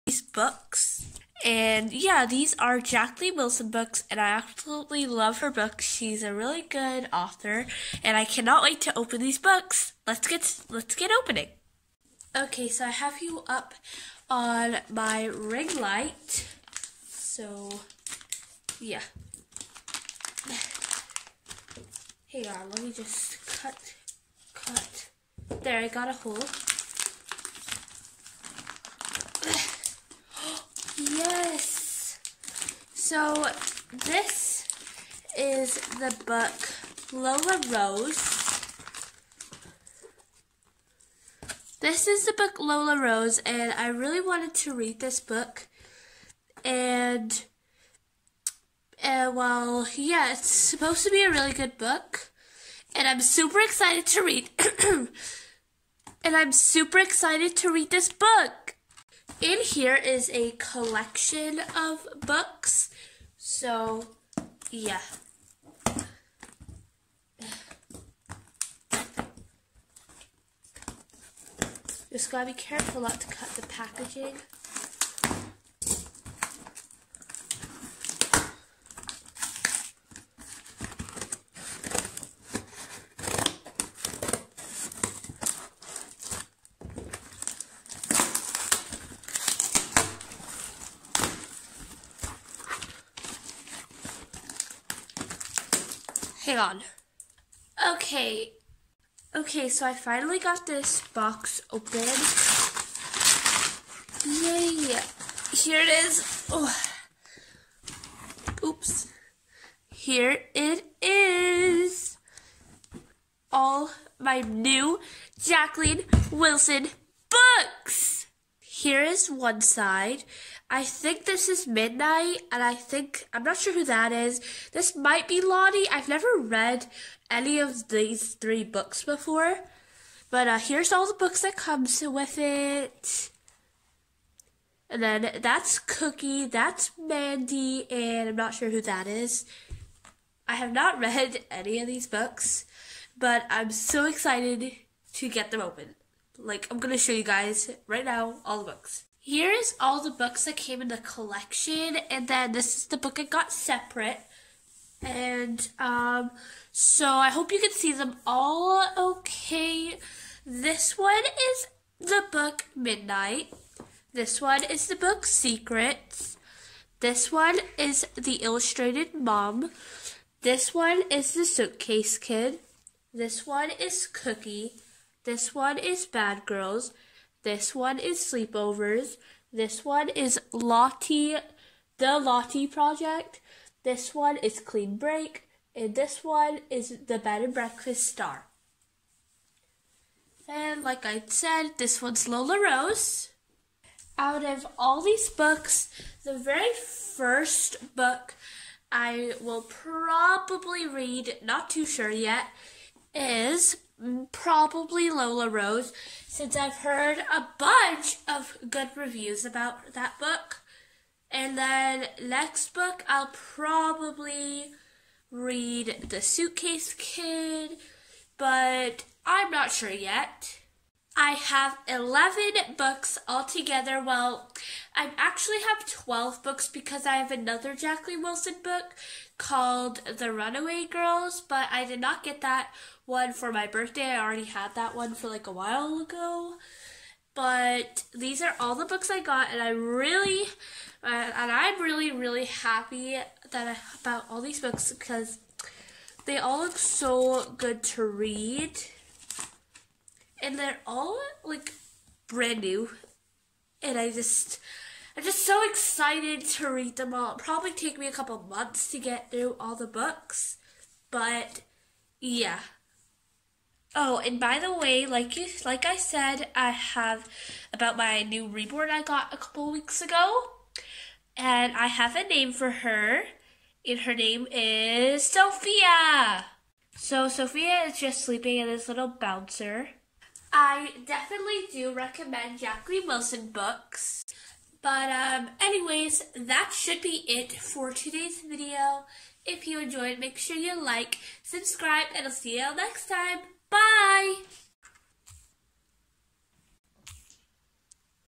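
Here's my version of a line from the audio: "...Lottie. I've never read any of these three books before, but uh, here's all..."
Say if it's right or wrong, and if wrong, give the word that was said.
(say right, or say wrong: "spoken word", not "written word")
right.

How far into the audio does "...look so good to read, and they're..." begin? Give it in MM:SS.
04:06.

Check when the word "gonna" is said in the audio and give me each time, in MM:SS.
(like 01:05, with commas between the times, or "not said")
02:26.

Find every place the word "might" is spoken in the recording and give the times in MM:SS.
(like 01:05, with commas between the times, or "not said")
02:04.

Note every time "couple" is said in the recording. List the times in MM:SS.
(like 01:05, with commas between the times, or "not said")
04:18, 04:29.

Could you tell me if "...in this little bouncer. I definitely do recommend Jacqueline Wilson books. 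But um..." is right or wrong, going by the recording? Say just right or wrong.
right.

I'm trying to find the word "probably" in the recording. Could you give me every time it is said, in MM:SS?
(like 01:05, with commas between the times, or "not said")
03:19, 03:24, 03:33, 04:17.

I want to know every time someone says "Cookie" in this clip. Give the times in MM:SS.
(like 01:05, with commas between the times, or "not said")
02:15, 02:54.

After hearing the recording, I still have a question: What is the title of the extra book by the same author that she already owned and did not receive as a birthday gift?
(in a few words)
The Runaway Girls.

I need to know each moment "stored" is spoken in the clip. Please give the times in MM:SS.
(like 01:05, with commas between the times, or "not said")
not said.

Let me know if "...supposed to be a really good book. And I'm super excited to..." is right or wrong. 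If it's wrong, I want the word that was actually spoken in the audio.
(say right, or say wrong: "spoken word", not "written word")
right.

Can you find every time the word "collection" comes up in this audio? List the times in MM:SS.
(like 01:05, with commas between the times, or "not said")
01:00, 02:30.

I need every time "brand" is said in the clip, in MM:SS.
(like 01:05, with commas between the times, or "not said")
04:12.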